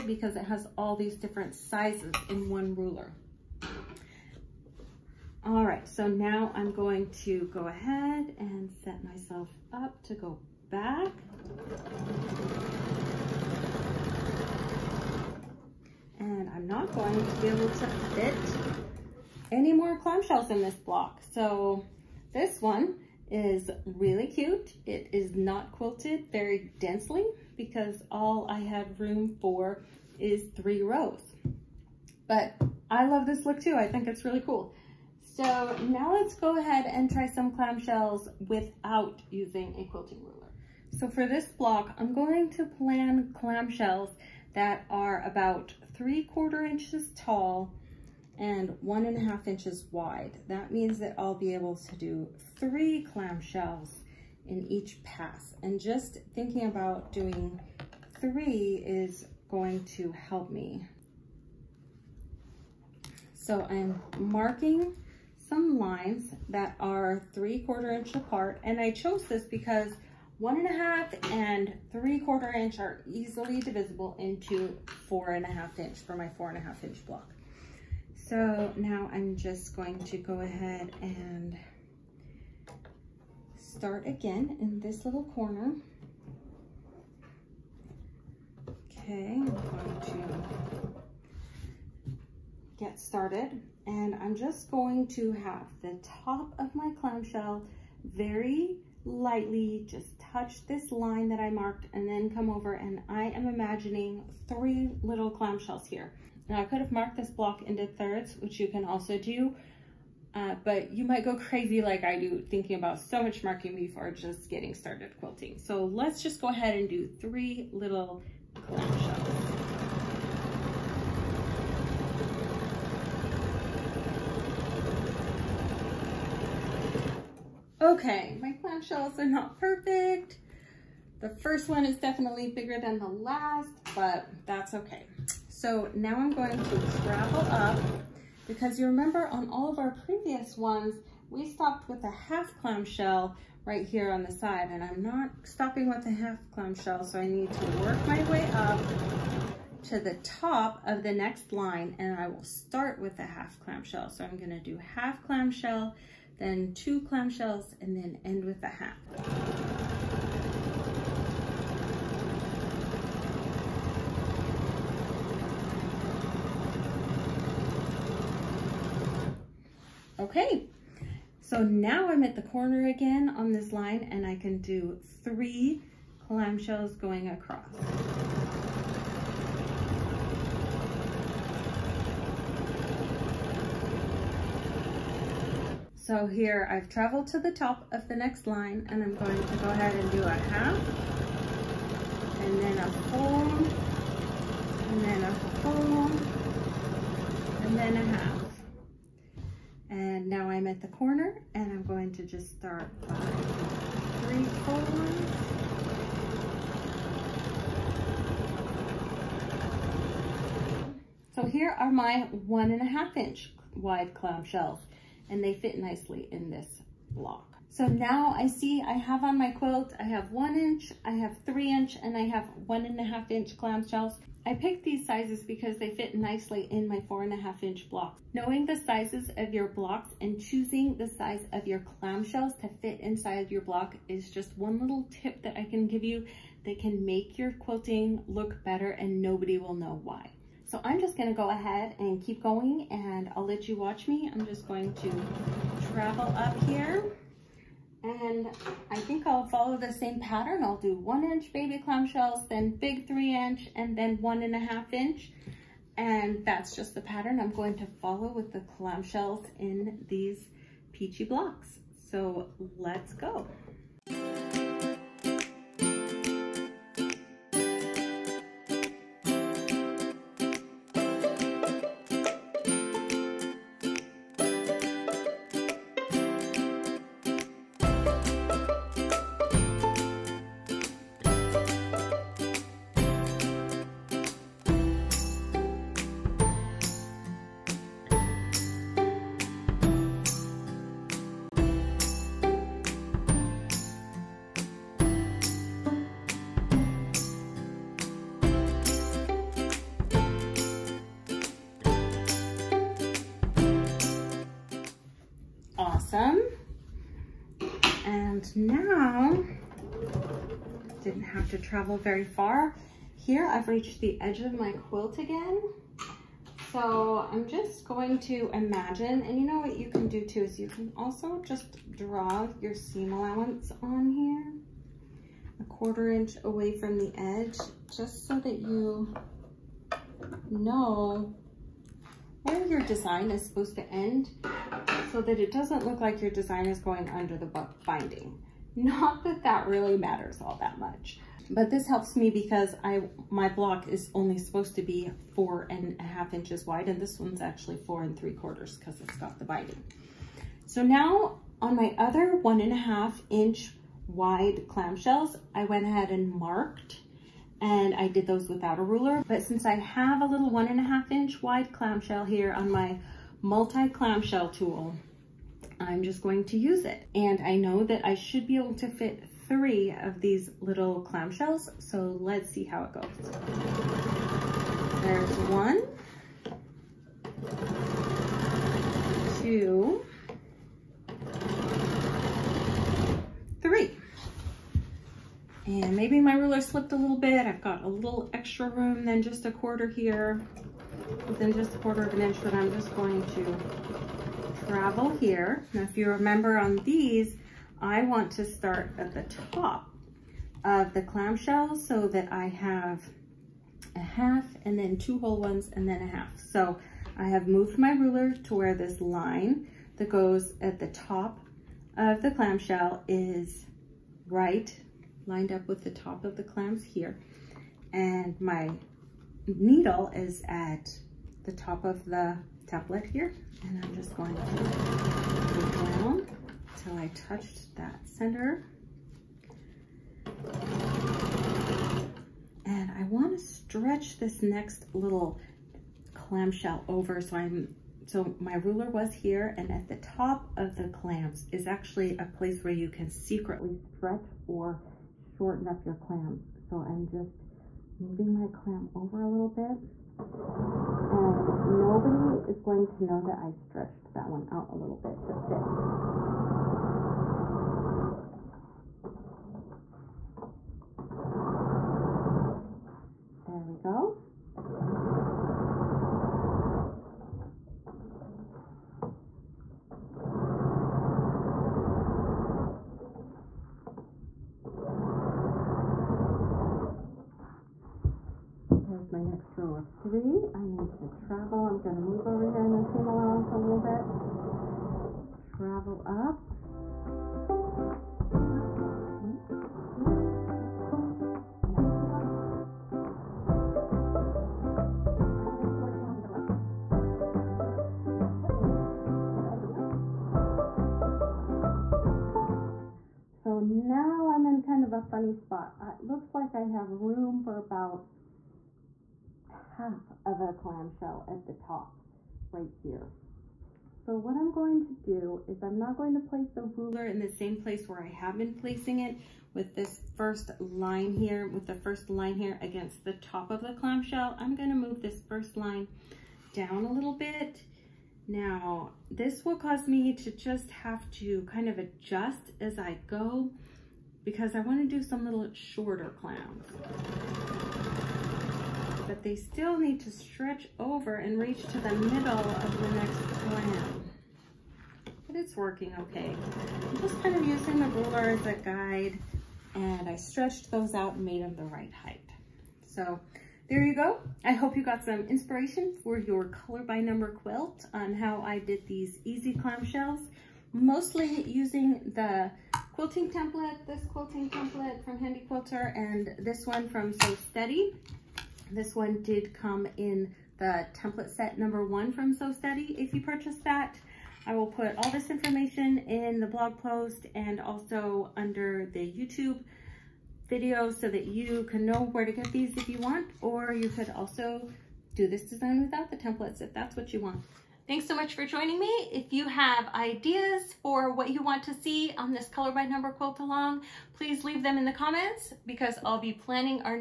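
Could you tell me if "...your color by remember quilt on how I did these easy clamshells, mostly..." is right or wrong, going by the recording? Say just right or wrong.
wrong.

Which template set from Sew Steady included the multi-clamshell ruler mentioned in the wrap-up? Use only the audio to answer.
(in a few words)
Set number 1.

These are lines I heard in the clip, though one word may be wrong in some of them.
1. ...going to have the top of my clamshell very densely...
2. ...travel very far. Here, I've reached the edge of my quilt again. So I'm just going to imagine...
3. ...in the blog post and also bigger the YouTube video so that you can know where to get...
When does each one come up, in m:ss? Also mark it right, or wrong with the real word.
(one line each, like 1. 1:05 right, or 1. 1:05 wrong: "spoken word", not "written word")
1. 1:34 wrong: "lightly", not "densely"
2. 5:11 right
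3. 9:35 wrong: "under", not "bigger".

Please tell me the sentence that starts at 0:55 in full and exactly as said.
And just thinking about doing three is going to help me.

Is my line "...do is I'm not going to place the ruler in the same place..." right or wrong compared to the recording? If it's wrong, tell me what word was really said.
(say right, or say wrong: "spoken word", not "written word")
right.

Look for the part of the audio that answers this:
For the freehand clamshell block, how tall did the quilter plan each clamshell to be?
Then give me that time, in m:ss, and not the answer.
0:45.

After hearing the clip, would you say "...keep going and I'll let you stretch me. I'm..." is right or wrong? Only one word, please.
wrong.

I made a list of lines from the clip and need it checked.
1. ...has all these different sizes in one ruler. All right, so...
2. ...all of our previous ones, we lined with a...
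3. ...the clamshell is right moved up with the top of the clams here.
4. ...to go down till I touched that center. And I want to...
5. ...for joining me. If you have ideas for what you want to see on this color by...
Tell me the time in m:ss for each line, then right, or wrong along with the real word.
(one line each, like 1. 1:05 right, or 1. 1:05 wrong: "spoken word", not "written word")
1. 0:00 right
2. 2:19 wrong: "stopped", not "lined"
3. 6:52 wrong: "lined", not "moved"
4. 7:04 right
5. 9:48 right.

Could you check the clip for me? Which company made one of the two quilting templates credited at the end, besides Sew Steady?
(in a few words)
Handi Quilter.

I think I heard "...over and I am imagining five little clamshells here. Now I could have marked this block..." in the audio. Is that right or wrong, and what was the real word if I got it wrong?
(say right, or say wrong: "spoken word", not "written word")
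wrong: "three", not "five".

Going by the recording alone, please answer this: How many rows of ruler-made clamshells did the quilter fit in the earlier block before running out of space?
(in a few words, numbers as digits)
3.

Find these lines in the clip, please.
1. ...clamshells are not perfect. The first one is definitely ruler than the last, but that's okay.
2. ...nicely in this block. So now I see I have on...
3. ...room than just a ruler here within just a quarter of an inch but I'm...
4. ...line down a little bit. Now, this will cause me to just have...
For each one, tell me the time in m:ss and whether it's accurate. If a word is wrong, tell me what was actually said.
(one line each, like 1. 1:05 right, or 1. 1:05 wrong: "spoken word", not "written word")
1. 2:08 wrong: "bigger", not "ruler"
2. 3:35 right
3. 6:28 wrong: "quarter", not "ruler"
4. 8:45 right.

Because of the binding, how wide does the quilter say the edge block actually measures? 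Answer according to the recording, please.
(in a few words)
4 3/4 inches.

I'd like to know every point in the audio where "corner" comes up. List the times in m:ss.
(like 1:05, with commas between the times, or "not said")
1:25, 2:52, 3:20.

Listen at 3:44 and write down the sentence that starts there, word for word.
I picked these sizes because they fit nicely in my four and a half inch blocks.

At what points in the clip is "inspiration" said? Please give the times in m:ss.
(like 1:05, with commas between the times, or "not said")
9:15.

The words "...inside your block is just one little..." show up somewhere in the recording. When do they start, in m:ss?
3:53.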